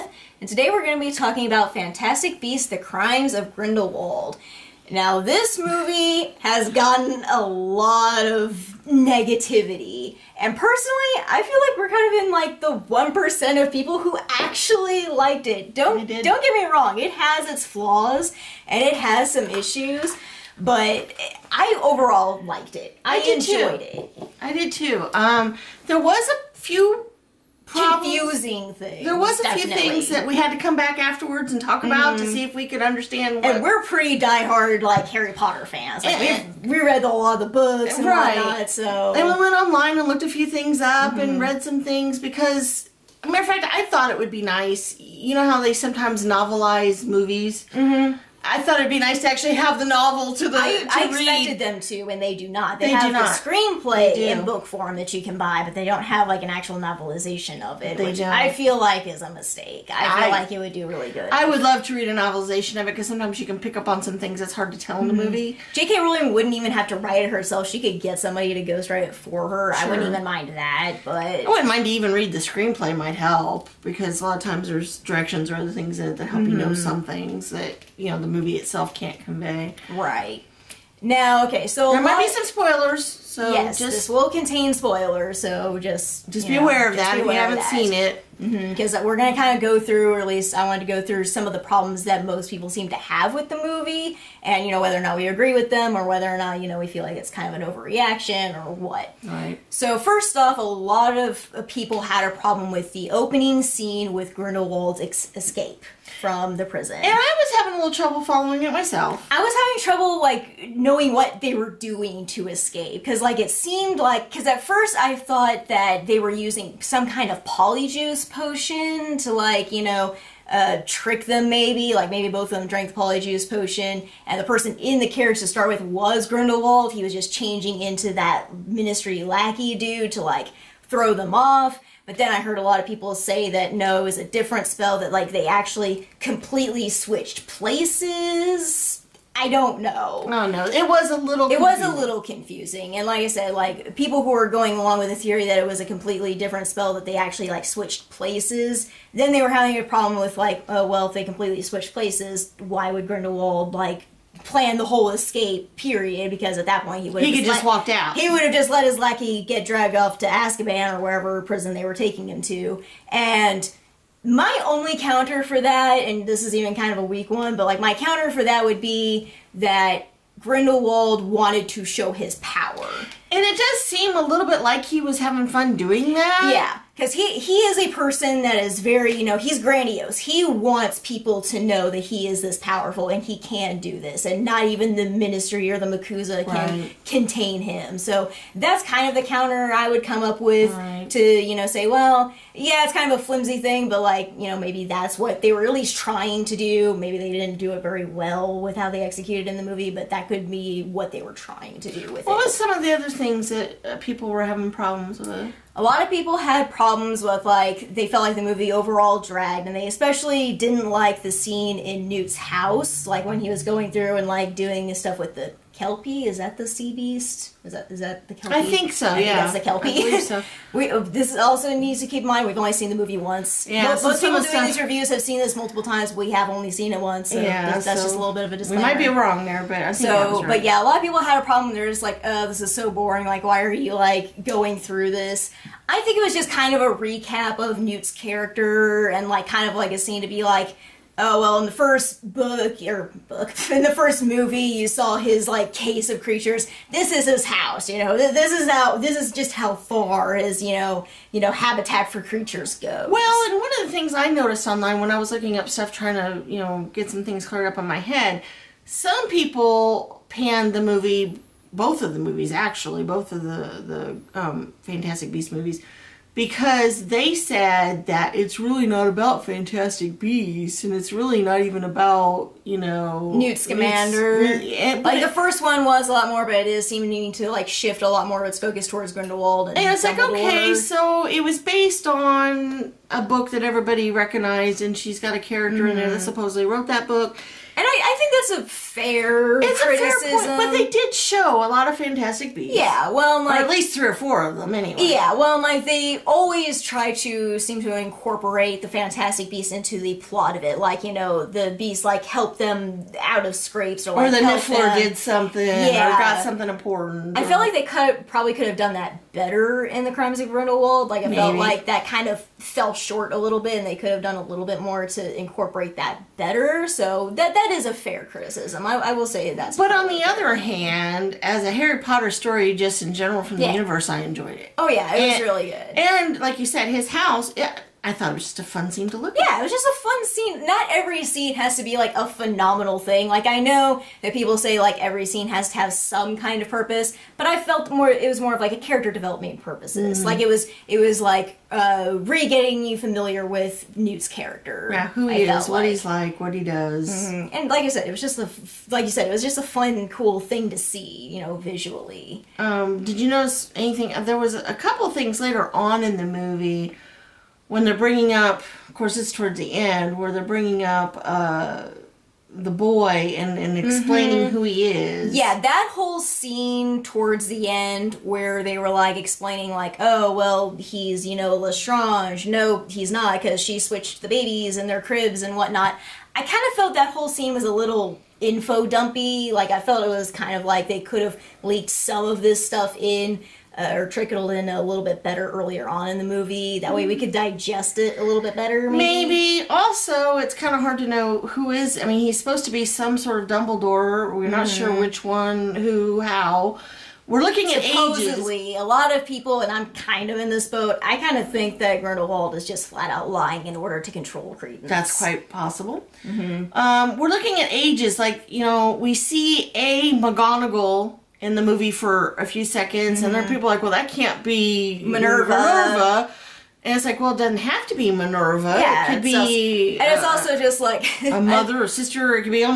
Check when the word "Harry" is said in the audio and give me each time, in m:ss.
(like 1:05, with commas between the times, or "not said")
0:35, 5:21.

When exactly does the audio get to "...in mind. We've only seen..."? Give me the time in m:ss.
3:42.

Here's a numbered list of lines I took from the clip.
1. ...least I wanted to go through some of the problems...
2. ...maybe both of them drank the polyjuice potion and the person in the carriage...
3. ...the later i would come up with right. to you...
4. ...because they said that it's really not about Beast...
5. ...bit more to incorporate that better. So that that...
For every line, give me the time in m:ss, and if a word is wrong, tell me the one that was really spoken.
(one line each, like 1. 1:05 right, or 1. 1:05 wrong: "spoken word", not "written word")
1. 1:30 right
2. 2:02 right
3. 3:09 wrong: "counter", not "later"
4. 4:26 wrong: "Fantastic", not "Beast"
5. 5:14 right.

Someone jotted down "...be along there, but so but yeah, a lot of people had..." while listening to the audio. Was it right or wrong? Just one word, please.
wrong.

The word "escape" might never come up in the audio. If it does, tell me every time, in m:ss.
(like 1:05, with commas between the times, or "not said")
1:45, 1:52, 2:35.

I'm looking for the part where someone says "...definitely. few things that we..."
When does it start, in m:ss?
0:29.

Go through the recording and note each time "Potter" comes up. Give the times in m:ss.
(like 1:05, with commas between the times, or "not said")
0:35, 5:22.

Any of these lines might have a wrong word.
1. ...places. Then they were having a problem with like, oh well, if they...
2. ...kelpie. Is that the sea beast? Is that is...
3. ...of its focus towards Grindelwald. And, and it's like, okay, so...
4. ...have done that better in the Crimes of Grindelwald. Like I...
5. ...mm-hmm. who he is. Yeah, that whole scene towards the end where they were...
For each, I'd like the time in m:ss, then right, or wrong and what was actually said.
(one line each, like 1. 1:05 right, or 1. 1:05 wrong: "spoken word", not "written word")
1. 2:28 right
2. 3:35 right
3. 4:38 right
4. 5:08 right
5. 6:04 right.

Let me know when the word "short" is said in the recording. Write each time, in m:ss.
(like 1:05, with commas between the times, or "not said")
5:12.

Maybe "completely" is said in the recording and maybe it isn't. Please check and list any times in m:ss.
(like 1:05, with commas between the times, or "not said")
2:16, 2:25, 2:31.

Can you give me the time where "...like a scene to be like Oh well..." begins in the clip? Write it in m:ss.
3:59.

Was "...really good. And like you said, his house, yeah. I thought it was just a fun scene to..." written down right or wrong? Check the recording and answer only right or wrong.
right.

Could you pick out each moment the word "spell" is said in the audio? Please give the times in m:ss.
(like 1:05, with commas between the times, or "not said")
2:14, 2:26.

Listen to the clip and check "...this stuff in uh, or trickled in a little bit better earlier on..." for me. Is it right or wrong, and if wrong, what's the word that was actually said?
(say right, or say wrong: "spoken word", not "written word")
right.